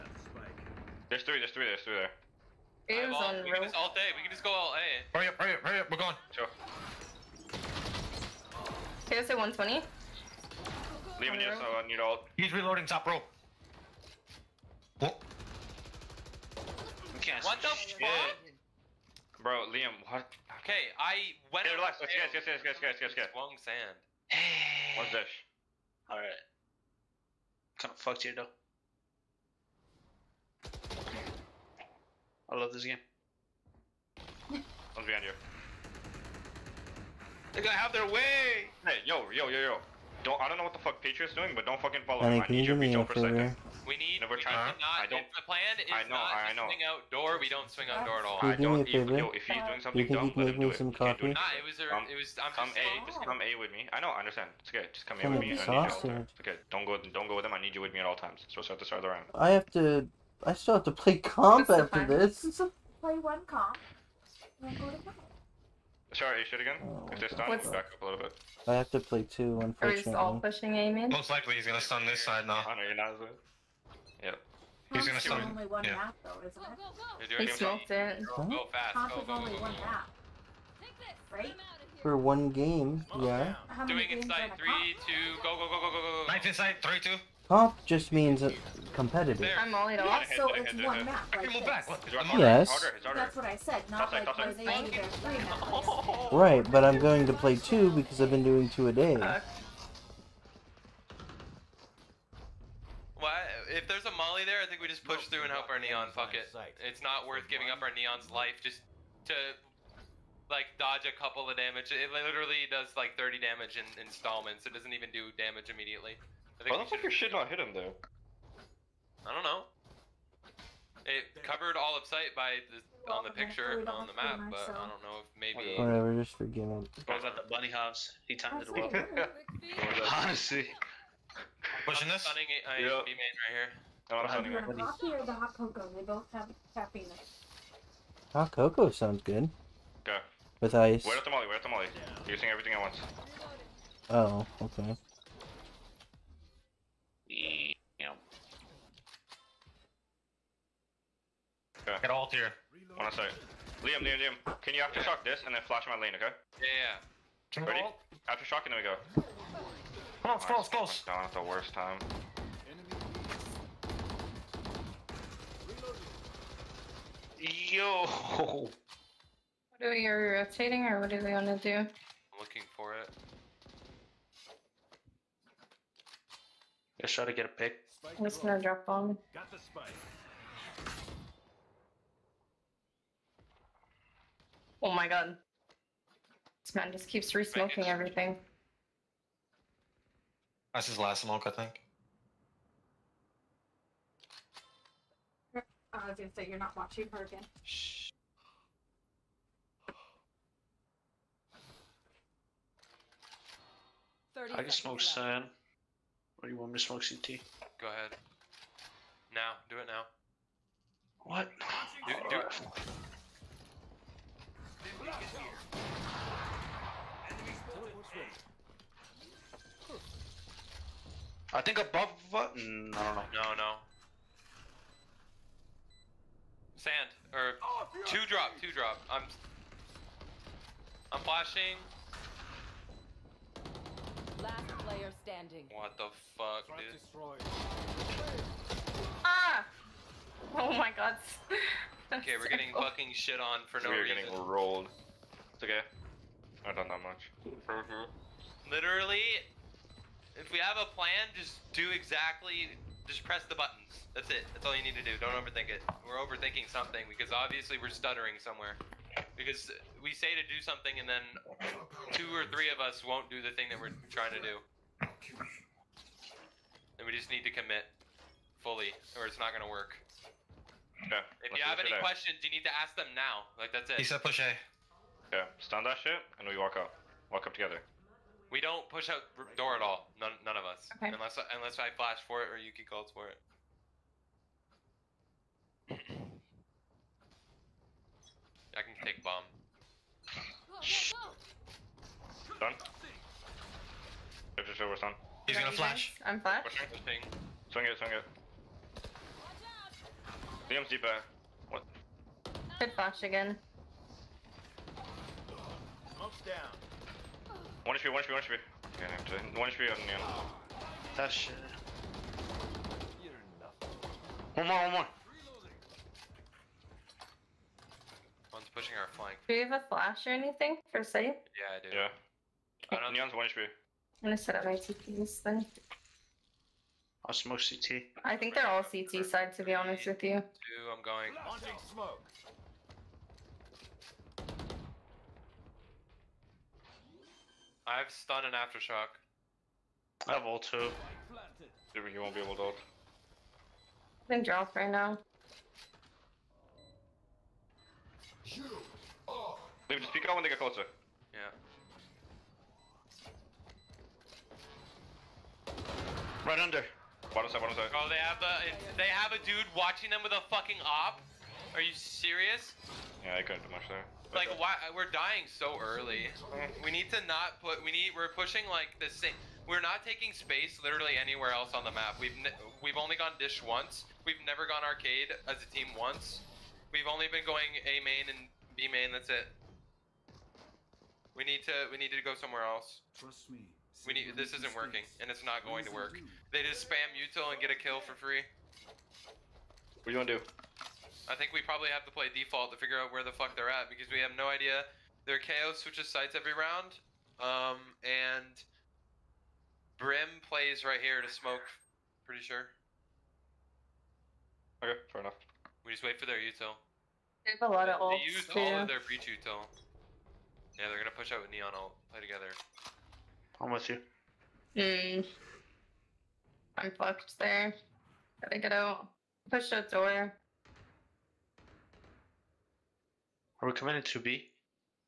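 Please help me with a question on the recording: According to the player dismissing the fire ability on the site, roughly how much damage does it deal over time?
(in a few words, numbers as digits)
30.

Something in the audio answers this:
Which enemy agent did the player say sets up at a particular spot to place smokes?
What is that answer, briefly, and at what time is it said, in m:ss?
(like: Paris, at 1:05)
Brim, at 6:39.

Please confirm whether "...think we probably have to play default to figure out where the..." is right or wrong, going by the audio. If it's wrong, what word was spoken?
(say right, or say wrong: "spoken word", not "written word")
right.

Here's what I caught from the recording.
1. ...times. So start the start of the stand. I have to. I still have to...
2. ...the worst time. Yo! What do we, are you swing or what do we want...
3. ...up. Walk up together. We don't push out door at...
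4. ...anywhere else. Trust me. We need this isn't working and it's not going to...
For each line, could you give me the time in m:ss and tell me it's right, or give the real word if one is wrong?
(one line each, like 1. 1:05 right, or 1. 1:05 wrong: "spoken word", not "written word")
1. 0:58 wrong: "round", not "stand"
2. 2:41 wrong: "rotating", not "swing"
3. 4:36 right
4. 6:22 wrong: "somewhere", not "anywhere".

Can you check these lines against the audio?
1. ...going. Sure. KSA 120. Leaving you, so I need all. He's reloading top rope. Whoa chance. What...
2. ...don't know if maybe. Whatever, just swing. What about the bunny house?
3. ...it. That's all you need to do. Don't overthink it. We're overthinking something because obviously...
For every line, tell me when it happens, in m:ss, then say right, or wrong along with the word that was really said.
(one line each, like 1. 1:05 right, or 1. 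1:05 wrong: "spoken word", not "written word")
1. 0:05 right
2. 2:04 wrong: "forgiving", not "swing"
3. 4:14 right.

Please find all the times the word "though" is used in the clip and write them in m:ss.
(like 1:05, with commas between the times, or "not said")
0:28, 1:16, 1:57.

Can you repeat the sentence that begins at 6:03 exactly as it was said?
Yeah, I couldn't do much there.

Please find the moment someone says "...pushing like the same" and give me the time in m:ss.
6:08.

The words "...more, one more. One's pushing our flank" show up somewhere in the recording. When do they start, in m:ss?
5:14.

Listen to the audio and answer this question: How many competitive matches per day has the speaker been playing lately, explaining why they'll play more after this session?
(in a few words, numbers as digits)
2.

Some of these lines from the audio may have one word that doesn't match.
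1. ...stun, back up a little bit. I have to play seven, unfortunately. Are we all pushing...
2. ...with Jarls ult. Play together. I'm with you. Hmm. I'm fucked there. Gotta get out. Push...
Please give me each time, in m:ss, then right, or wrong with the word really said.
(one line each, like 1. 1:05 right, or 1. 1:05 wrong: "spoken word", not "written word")
1. 1:07 wrong: "two", not "seven"
2. 6:51 wrong: "Neon", not "Jarls".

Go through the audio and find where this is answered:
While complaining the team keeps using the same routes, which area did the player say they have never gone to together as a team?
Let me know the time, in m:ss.
6:14.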